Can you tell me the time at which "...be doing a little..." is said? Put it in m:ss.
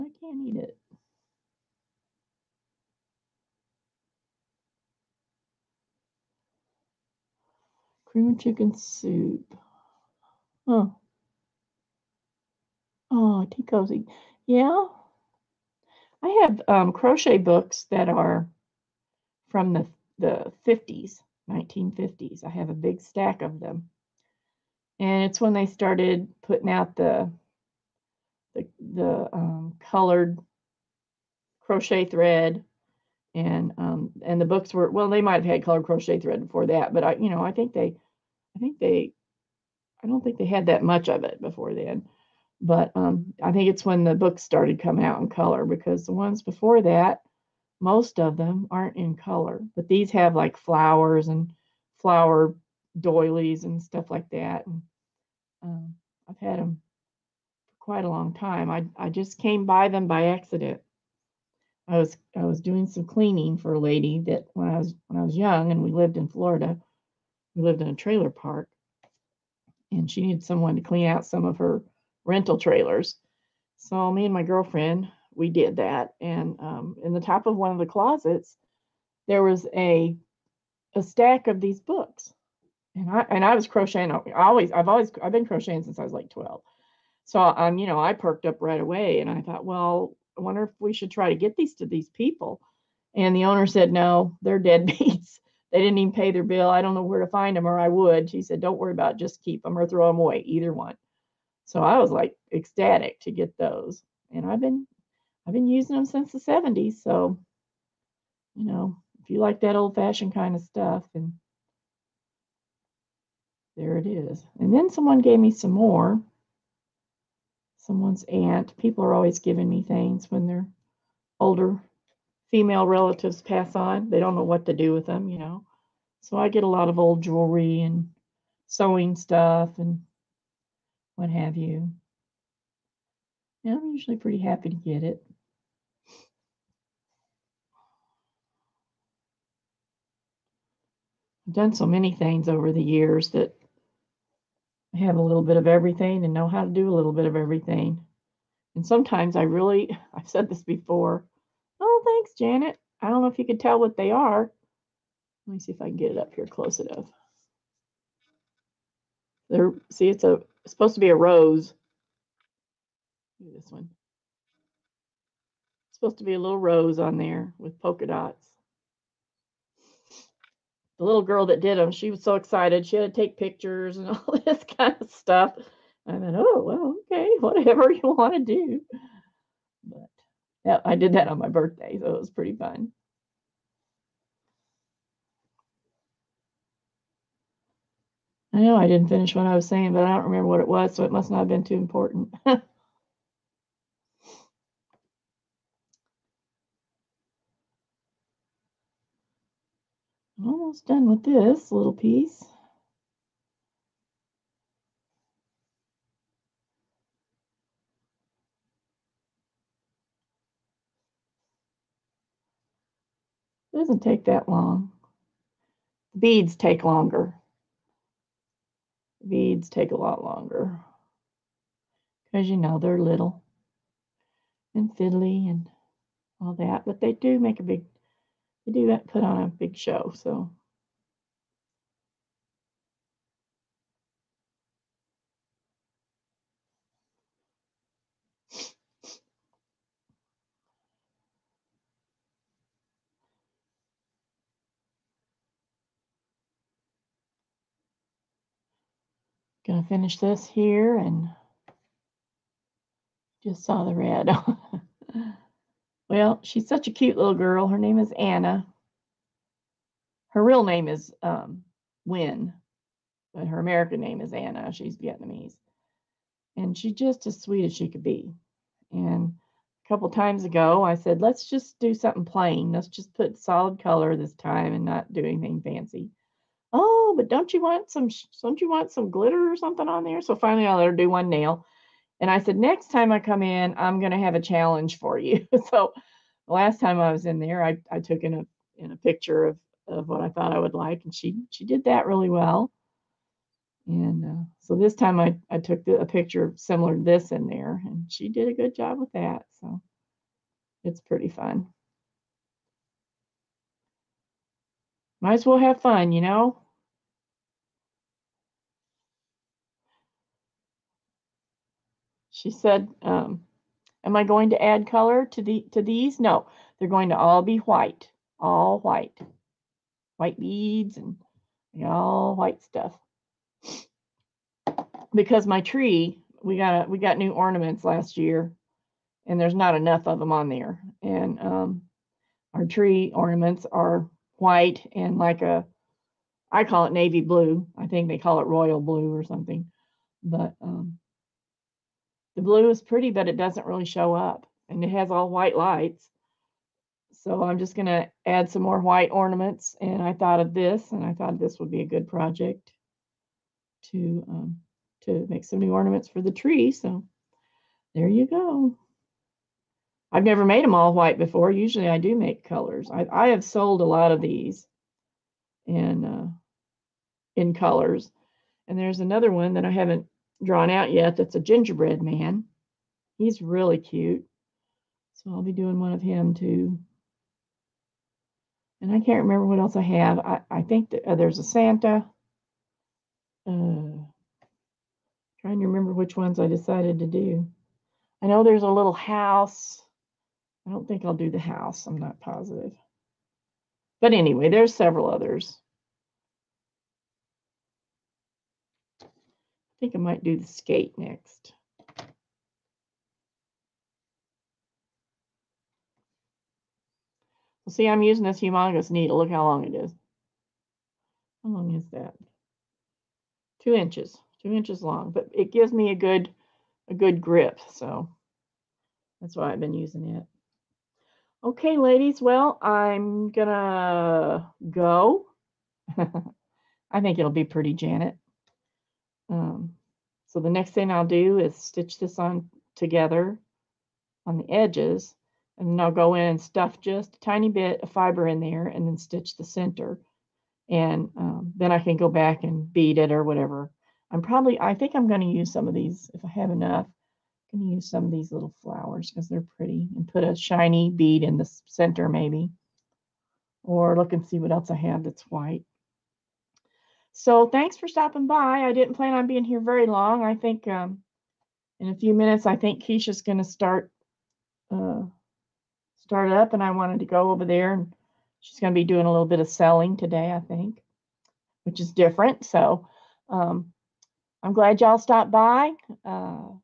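7:48.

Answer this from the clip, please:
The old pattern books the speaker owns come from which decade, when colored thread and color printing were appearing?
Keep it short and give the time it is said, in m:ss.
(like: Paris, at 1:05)
1950s, at 0:21.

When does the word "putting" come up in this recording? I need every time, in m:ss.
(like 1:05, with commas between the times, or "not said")
0:26.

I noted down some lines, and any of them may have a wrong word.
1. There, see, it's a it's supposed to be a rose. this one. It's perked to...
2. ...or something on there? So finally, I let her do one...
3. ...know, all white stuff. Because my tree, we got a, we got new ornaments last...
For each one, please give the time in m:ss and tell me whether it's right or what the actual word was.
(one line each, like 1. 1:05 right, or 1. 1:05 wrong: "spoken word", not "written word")
1. 2:39 wrong: "supposed", not "perked"
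2. 4:39 right
3. 5:21 right.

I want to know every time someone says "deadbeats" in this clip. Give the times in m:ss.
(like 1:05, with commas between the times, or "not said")
1:34.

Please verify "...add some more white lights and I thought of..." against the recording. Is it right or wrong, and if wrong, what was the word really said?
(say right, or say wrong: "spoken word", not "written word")
wrong: "ornaments", not "lights".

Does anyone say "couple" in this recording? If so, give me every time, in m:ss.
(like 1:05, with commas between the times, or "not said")
4:29.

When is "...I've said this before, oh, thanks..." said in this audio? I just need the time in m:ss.
2:30.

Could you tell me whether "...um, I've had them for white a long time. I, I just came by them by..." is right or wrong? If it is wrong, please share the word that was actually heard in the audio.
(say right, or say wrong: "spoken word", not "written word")
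wrong: "quite", not "white".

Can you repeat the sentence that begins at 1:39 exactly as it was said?
Just keep them or throw them away, either one.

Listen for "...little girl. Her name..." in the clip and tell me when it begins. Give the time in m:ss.
4:17.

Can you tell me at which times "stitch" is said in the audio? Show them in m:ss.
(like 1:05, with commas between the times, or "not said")
7:11, 7:18.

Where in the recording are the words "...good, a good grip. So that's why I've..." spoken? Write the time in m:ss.
6:55.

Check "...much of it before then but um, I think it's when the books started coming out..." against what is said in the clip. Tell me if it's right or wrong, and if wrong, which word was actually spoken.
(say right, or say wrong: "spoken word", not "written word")
right.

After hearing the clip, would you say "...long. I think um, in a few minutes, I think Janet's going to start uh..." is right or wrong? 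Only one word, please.
wrong.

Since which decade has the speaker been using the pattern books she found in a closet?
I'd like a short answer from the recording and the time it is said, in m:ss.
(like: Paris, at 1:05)
the 70s, at 1:46.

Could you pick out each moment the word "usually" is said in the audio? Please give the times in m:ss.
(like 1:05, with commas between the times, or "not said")
2:13, 6:01.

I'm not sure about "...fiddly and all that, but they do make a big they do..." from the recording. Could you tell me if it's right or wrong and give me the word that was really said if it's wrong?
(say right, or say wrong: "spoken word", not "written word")
right.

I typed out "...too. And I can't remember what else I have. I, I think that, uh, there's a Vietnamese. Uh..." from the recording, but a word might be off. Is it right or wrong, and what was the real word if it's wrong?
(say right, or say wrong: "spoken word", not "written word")
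wrong: "Santa", not "Vietnamese".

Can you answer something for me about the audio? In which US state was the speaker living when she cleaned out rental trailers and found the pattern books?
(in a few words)
Florida.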